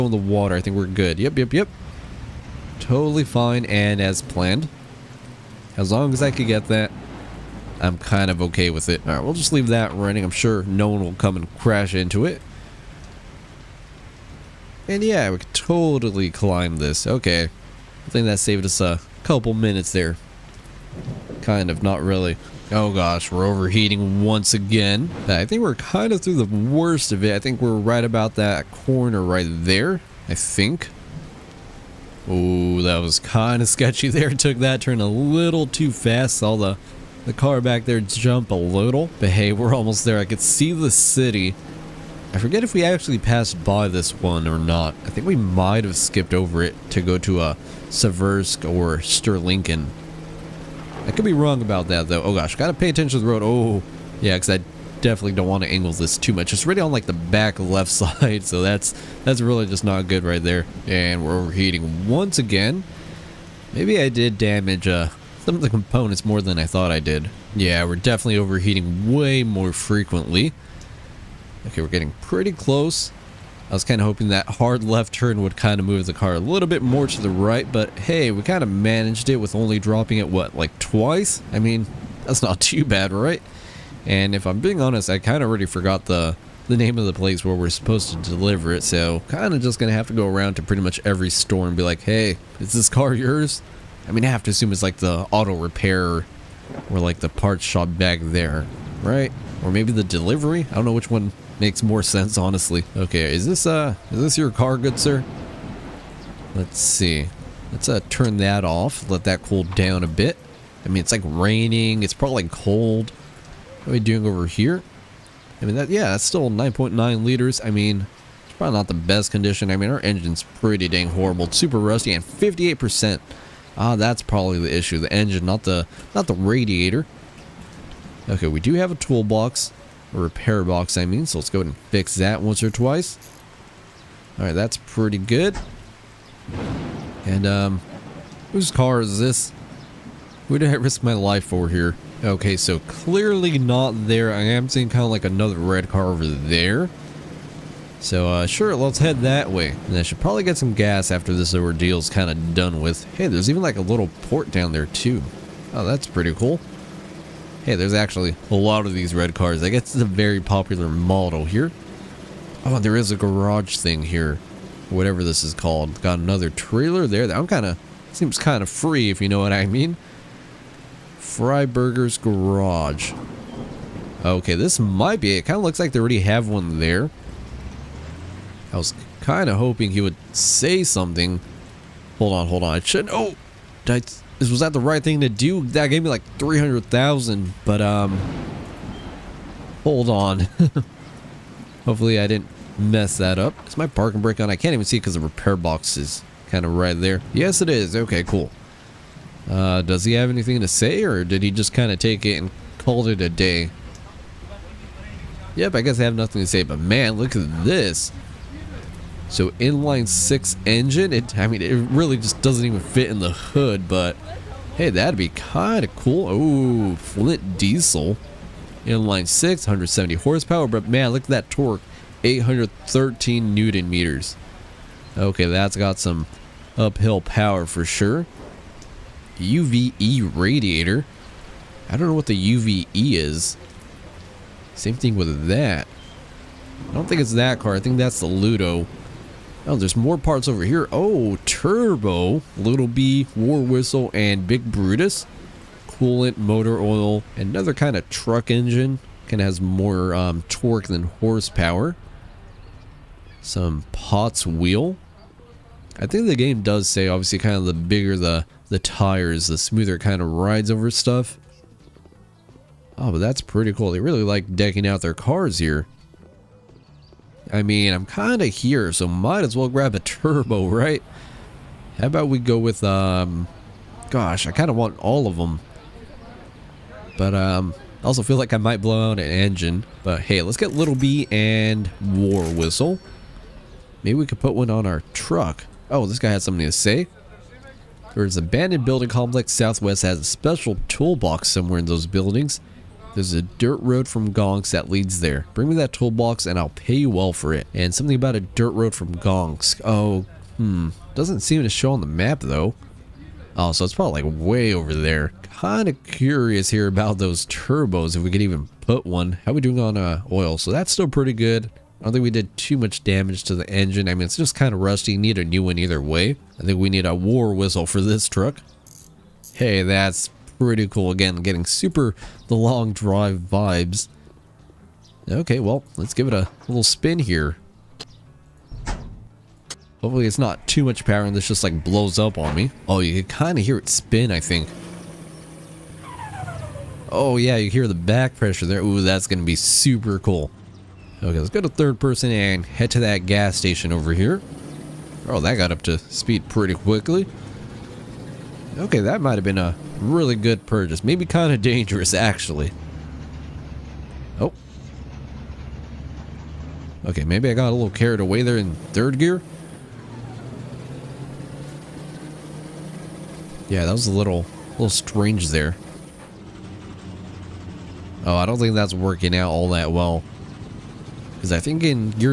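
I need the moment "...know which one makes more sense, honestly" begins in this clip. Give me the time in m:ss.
1:40.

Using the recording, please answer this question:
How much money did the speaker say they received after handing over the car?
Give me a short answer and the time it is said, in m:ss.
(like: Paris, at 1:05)
300,000, at 3:06.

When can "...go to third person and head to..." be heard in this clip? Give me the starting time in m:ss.
5:41.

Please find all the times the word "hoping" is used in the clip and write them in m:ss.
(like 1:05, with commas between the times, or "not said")
1:14, 2:59.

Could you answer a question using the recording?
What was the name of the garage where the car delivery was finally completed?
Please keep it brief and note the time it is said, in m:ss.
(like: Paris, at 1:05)
Freiburger's Garage, at 2:51.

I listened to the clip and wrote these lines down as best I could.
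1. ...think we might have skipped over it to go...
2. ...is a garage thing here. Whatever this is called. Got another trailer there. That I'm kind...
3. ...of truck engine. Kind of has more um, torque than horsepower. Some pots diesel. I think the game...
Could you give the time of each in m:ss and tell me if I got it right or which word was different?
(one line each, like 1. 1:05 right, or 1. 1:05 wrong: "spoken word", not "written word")
1. 0:45 right
2. 2:42 right
3. 4:07 wrong: "wheel", not "diesel".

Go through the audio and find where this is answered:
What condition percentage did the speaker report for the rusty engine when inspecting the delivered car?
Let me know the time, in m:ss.
2:02.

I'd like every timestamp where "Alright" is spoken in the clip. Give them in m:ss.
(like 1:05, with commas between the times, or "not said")
0:09, 2:14.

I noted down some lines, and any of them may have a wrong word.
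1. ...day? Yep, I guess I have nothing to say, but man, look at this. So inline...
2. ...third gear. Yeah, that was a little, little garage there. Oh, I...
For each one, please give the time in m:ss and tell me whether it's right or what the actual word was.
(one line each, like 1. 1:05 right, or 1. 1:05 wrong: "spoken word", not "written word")
1. 3:23 right
2. 5:58 wrong: "strange", not "garage".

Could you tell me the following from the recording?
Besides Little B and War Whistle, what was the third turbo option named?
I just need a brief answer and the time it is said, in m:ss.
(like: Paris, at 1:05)
Big Brutus, at 4:04.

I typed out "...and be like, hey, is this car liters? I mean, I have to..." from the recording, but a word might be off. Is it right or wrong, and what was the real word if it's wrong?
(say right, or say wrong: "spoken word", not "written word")
wrong: "yours", not "liters".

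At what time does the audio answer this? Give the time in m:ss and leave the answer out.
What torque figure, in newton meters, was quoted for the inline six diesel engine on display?
3:42.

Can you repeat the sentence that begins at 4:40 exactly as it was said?
But hey, let's get Little B and War Whistle.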